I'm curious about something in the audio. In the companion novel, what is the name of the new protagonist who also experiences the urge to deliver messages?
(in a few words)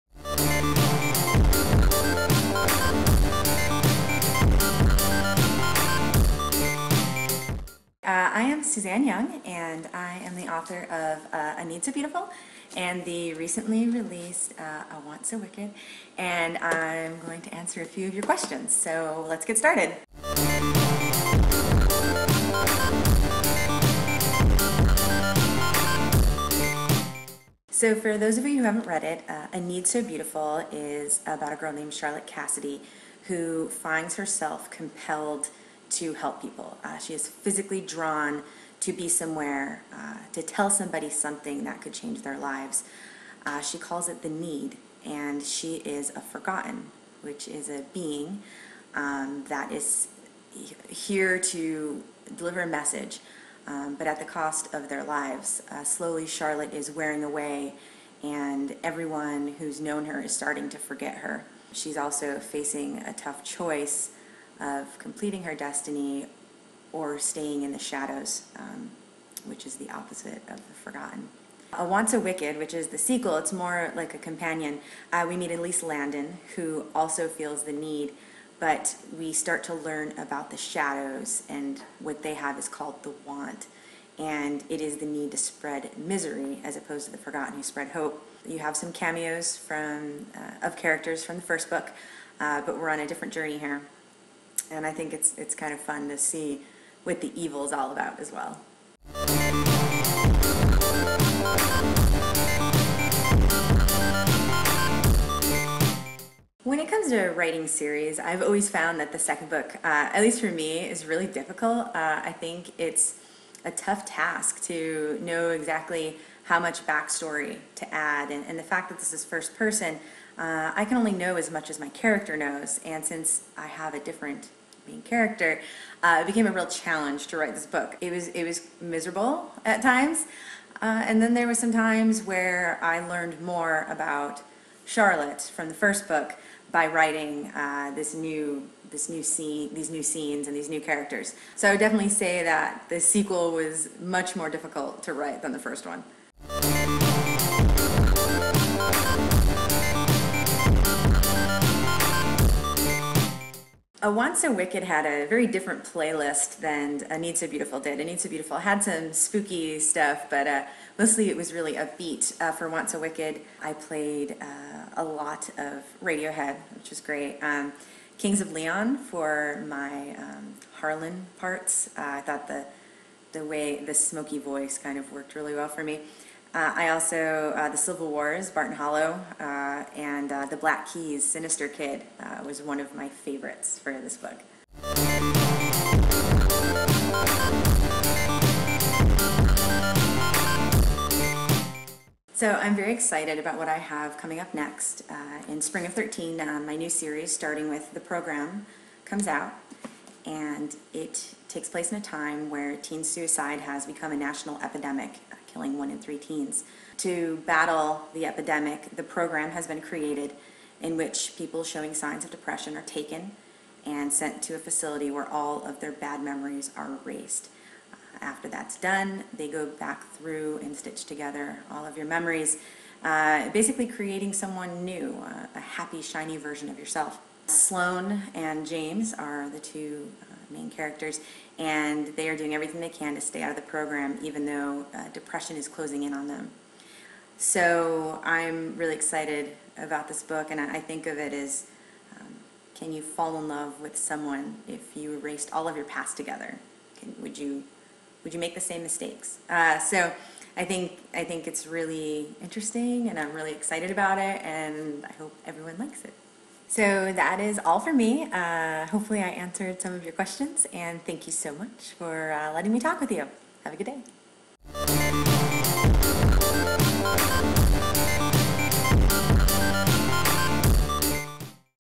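Elise Landon.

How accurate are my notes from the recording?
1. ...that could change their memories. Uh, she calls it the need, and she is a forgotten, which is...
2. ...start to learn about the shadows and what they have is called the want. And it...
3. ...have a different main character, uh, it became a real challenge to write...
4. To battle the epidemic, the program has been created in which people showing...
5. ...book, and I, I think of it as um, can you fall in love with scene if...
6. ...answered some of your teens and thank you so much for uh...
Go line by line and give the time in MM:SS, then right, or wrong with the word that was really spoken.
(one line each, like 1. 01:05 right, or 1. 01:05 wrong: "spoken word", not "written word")
1. 00:41 wrong: "lives", not "memories"
2. 01:19 right
3. 02:03 right
4. 03:26 right
5. 04:00 wrong: "someone", not "scene"
6. 04:19 wrong: "questions", not "teens".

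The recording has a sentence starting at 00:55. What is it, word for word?
Uh, slowly, Charlotte is wearing away, and everyone who's known her is starting to forget her.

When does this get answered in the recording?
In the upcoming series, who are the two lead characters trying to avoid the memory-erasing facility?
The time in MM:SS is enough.
03:47.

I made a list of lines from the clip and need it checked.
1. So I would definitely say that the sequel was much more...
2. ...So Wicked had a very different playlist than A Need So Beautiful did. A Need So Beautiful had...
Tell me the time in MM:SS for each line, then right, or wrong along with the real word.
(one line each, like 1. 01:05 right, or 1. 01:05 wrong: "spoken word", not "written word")
1. 02:21 right
2. 02:34 right.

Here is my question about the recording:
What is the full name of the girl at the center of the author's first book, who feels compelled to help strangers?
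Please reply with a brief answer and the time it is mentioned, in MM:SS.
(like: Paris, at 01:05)
Charlotte Cassidy, at 00:31.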